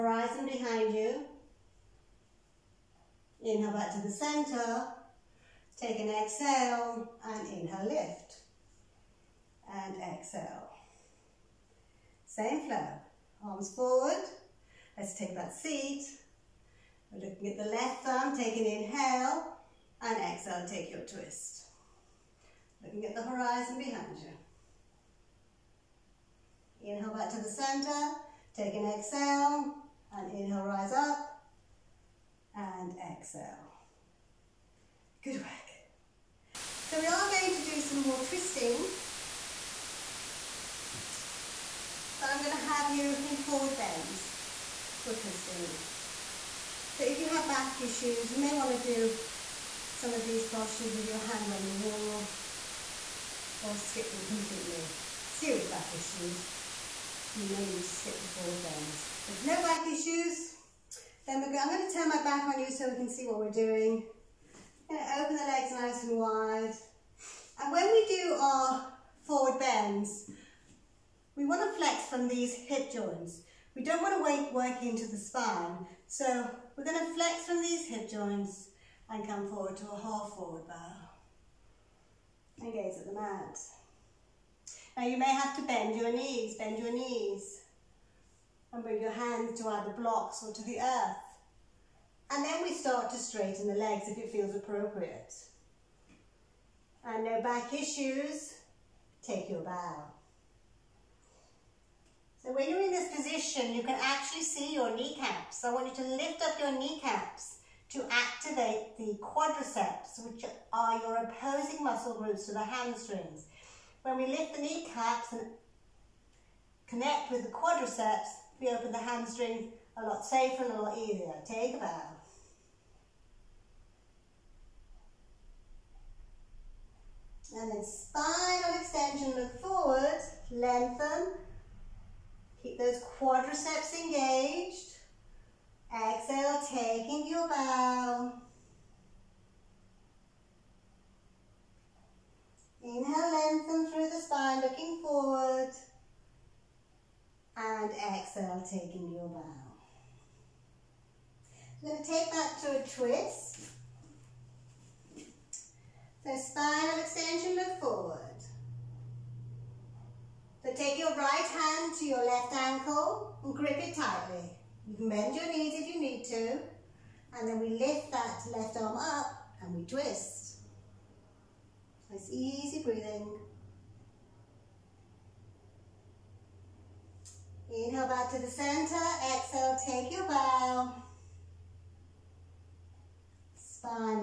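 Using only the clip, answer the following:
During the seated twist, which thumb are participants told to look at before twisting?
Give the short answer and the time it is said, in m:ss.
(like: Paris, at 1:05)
Left thumb, at 0:17.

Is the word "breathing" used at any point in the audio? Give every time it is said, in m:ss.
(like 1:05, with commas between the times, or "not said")
2:52.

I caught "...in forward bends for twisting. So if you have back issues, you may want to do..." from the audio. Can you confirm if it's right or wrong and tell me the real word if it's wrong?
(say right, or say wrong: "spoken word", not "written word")
right.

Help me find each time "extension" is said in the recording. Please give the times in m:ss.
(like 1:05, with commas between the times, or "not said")
2:08, 2:36.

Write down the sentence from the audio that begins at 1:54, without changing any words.
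When we lift the kneecaps and connect with the quadriceps, we open the hamstrings a lot safer and a lot easier.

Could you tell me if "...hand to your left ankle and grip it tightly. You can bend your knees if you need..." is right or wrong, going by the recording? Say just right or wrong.
right.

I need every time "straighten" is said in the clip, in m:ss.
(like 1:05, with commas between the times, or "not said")
1:33.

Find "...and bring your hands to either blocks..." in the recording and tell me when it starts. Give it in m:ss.
1:28.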